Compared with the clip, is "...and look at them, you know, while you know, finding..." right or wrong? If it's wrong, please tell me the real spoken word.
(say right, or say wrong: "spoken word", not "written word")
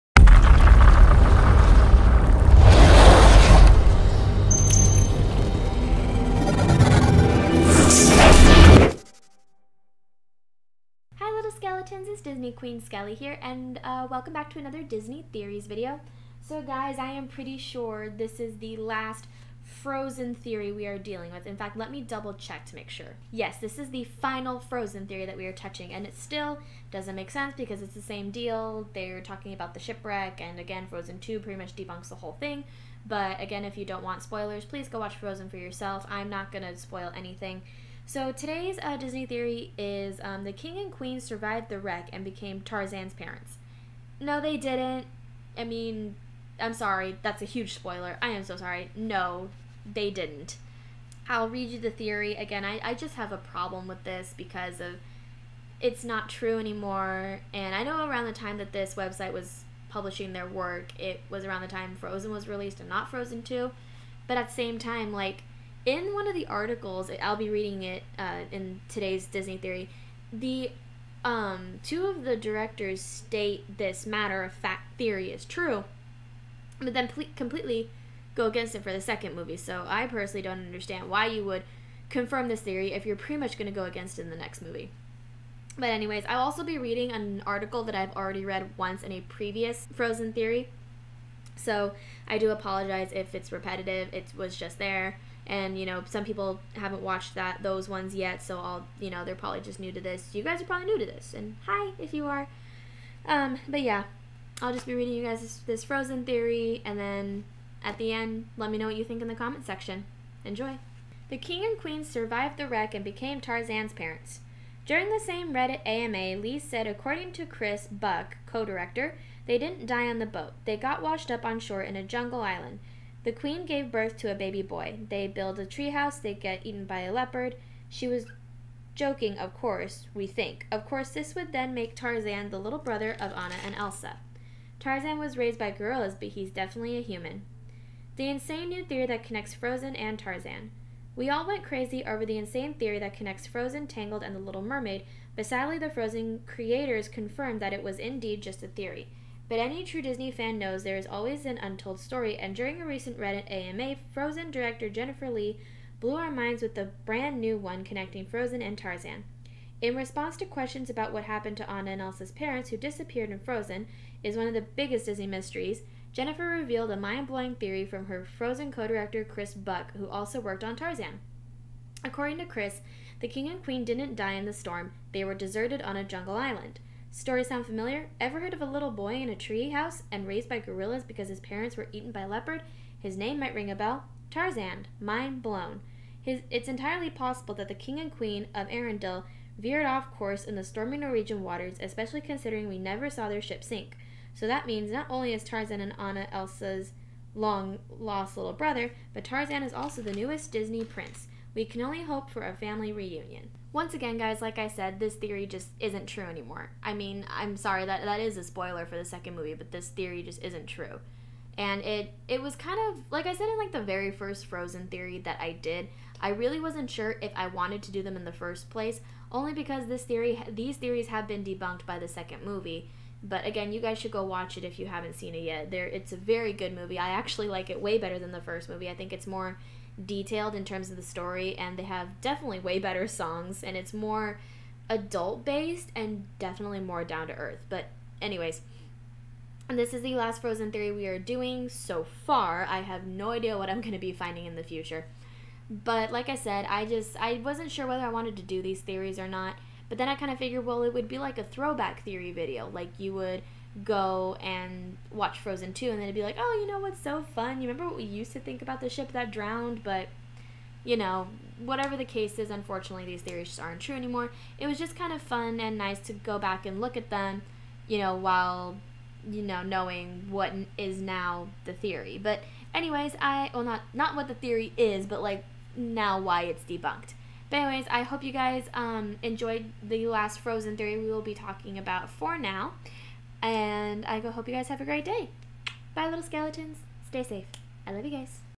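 wrong: "knowing", not "finding".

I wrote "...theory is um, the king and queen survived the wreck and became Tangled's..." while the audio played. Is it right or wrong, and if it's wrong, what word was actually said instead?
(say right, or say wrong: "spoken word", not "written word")
wrong: "Tarzan", not "Tangled".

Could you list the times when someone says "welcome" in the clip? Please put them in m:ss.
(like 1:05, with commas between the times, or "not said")
0:14.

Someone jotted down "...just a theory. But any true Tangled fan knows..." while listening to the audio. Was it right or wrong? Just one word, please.
wrong.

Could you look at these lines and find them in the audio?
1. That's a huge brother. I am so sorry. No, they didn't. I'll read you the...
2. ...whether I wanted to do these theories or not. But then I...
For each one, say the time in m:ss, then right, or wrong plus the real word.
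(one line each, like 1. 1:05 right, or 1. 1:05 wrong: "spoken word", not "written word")
1. 0:47 wrong: "spoiler", not "brother"
2. 4:07 right.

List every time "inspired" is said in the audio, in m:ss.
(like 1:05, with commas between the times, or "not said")
not said.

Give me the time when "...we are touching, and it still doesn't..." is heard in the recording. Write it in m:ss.
0:25.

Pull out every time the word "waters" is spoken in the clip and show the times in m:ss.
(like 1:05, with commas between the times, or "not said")
3:11.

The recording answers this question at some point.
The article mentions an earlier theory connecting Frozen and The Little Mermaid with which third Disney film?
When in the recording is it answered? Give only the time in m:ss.
2:23.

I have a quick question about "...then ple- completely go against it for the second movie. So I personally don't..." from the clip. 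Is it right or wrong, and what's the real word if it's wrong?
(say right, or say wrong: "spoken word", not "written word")
right.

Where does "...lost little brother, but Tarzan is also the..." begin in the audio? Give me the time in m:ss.
3:17.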